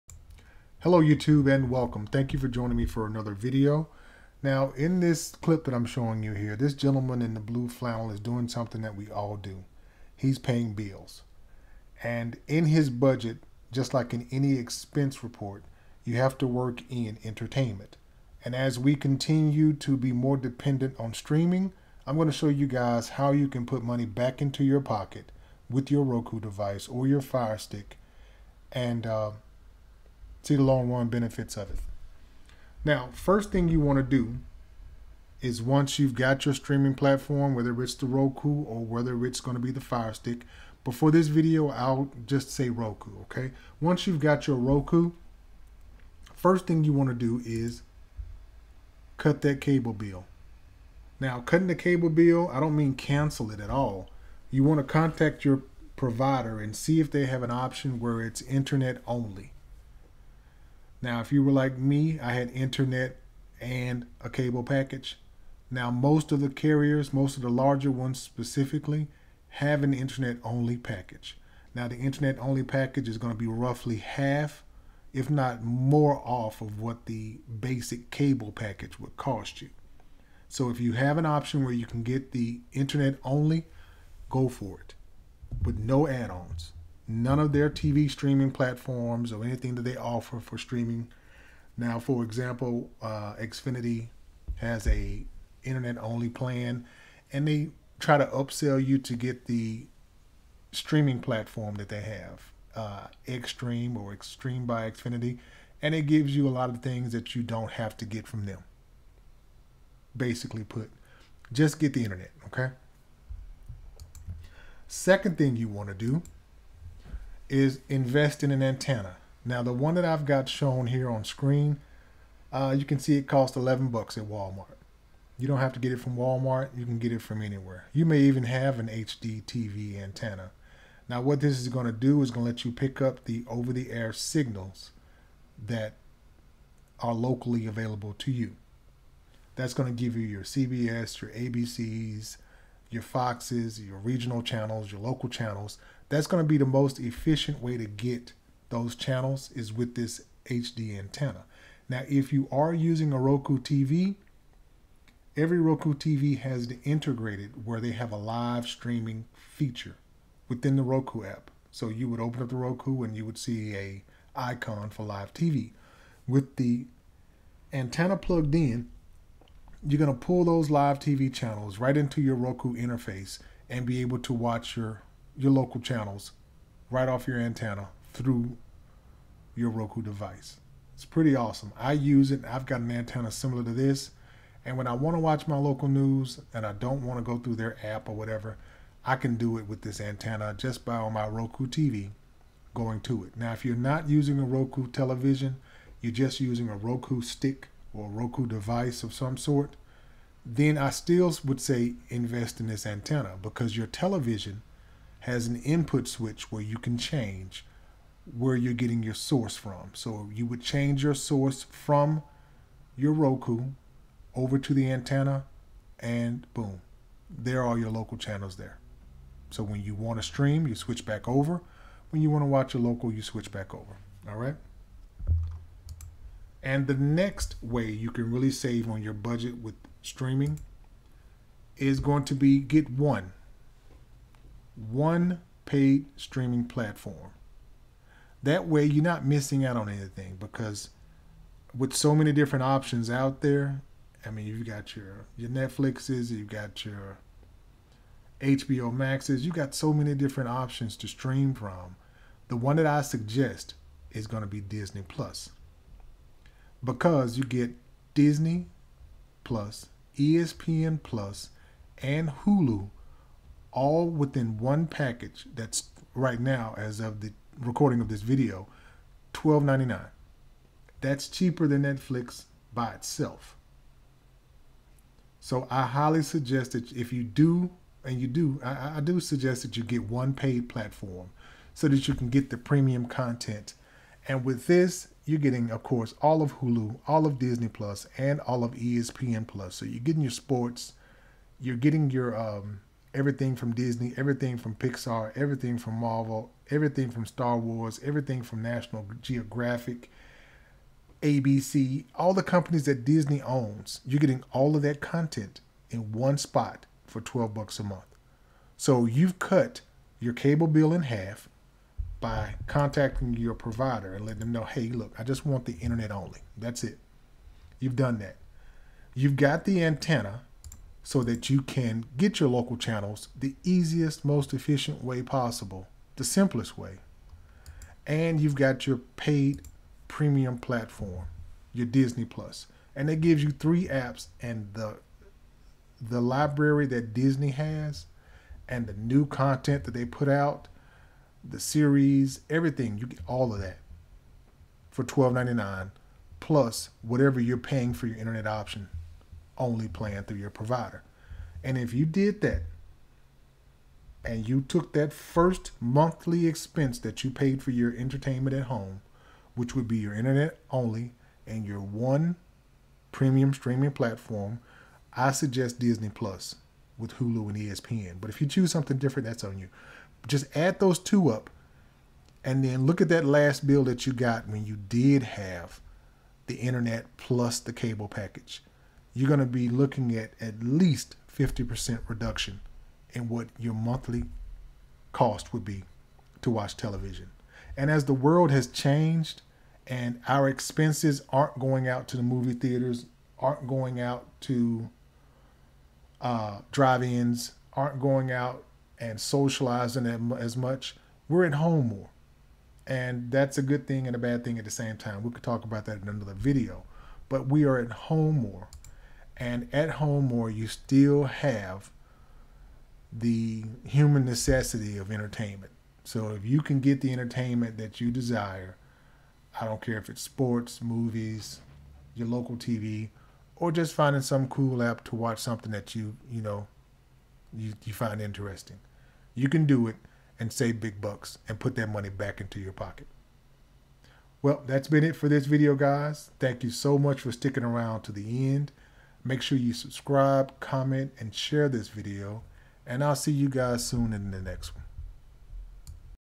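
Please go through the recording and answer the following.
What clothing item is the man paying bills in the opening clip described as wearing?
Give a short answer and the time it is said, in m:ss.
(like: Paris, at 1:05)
Blue flannel, at 0:07.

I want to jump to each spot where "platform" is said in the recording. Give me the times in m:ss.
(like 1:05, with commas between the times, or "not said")
0:36, 1:28, 1:41, 3:56, 4:40, 5:30, 6:03.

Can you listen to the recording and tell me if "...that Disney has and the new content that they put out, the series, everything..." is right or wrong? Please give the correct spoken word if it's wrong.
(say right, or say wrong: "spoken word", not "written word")
right.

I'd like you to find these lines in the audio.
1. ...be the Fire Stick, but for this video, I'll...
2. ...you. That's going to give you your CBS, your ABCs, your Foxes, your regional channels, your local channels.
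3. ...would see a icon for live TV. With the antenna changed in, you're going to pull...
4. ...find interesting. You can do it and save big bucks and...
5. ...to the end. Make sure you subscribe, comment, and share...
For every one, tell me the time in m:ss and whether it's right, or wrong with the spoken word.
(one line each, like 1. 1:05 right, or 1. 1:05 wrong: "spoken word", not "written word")
1. 0:39 right
2. 2:18 right
3. 2:43 wrong: "plugged", not "changed"
4. 7:07 right
5. 7:18 right.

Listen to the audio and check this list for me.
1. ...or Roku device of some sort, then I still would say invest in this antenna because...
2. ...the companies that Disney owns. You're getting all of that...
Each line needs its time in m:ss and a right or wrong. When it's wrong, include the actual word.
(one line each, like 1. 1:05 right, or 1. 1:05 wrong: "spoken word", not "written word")
1. 3:17 right
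2. 5:02 right.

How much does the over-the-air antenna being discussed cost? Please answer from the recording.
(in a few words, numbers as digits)
$11.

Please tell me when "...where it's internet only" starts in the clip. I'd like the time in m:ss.
0:57.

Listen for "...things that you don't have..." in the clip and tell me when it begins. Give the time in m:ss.
1:46.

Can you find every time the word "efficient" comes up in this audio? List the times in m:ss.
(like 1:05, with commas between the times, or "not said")
2:26, 5:24.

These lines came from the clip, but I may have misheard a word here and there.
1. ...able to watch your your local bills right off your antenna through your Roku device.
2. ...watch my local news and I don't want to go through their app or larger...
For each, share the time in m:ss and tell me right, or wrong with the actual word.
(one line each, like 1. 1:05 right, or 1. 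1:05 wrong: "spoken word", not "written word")
1. 2:54 wrong: "channels", not "bills"
2. 3:05 wrong: "whatever", not "larger".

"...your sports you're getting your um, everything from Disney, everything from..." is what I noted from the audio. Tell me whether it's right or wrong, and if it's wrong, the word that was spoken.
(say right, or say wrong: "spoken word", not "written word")
right.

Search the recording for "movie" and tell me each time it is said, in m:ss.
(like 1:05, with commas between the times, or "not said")
6:32, 7:00.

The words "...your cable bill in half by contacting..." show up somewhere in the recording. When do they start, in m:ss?
5:10.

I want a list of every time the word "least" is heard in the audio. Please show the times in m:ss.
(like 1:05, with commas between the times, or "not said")
6:20.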